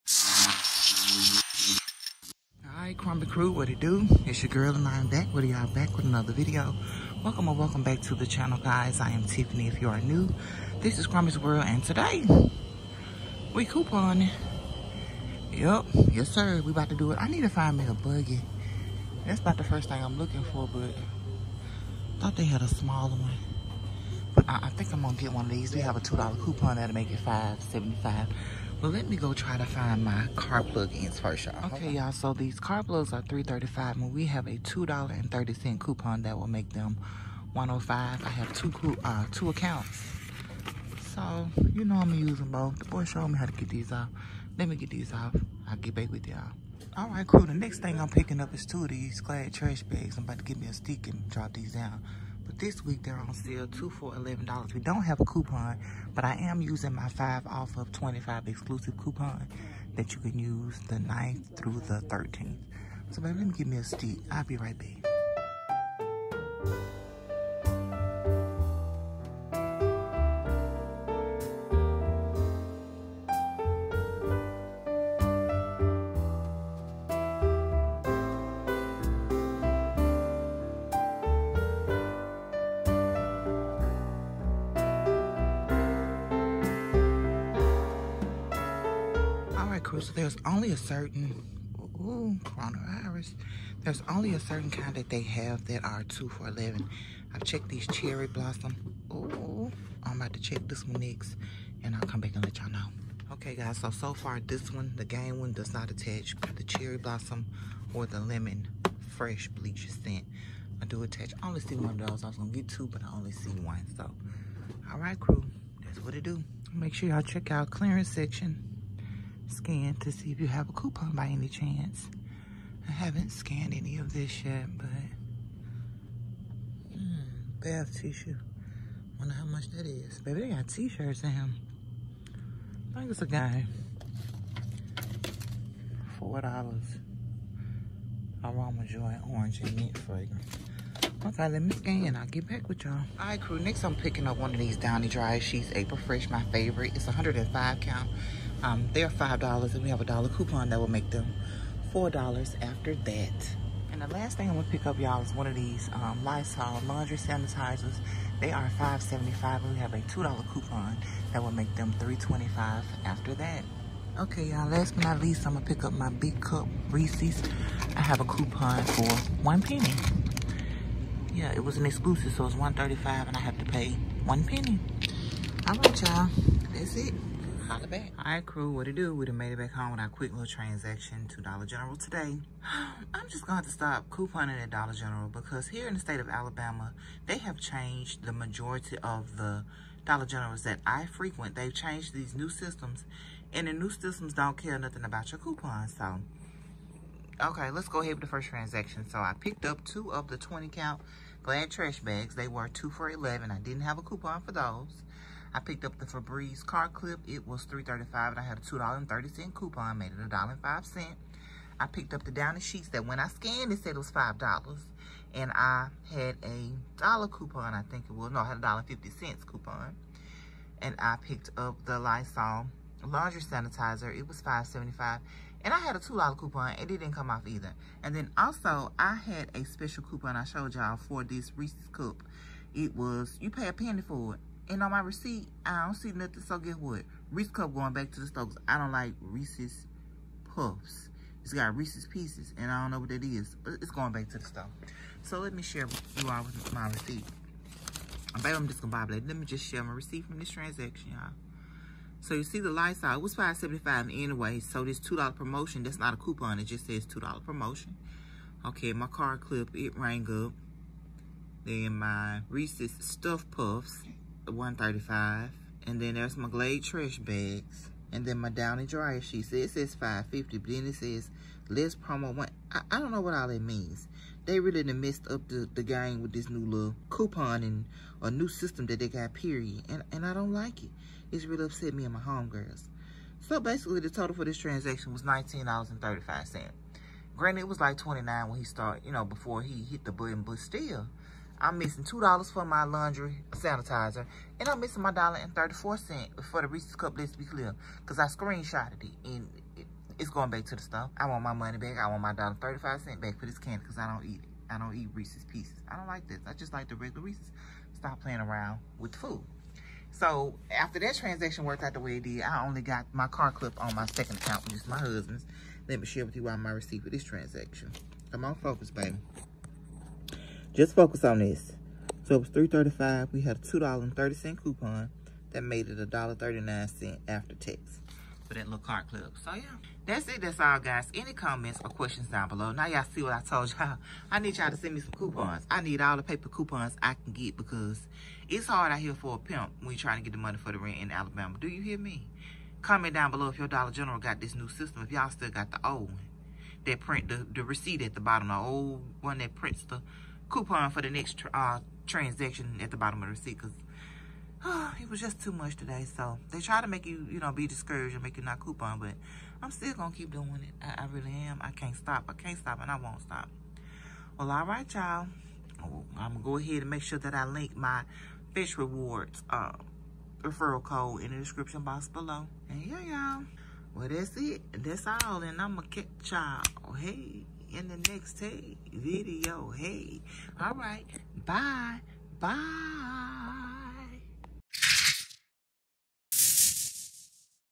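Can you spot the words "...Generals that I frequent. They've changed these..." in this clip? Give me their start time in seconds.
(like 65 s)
190 s.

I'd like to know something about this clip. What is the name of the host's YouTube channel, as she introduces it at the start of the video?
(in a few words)
Crombie's World.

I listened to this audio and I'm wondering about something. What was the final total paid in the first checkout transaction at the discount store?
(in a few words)
$19.35.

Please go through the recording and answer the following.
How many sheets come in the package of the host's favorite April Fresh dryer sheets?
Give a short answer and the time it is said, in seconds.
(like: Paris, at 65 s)
105, at 147 s.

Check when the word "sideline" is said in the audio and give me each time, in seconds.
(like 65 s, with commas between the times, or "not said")
not said.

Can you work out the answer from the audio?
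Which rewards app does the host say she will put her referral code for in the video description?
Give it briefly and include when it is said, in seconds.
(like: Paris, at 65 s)
Fetch rewards, at 368 s.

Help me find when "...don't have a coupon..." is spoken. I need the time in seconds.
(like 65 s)
54 s.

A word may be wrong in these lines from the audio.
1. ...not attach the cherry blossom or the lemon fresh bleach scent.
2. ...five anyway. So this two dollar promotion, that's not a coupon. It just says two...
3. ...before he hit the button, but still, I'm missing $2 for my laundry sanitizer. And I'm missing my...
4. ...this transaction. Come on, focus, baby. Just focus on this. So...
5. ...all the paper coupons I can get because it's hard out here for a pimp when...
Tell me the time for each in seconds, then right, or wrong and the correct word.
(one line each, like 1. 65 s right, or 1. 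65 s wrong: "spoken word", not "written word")
1. 105 s right
2. 253 s right
3. 289 s right
4. 317 s right
5. 335 s right.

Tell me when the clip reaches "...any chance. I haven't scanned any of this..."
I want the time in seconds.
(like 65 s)
121 s.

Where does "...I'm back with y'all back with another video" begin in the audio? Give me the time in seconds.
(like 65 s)
4 s.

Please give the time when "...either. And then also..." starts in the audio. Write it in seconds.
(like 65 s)
227 s.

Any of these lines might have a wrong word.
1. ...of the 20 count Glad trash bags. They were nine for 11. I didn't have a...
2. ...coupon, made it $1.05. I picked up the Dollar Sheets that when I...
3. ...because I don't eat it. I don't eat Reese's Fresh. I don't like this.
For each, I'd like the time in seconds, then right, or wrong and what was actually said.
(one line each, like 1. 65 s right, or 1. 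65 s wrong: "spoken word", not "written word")
1. 200 s wrong: "two", not "nine"
2. 209 s wrong: "Downy", not "Dollar"
3. 303 s wrong: "Pieces", not "Fresh".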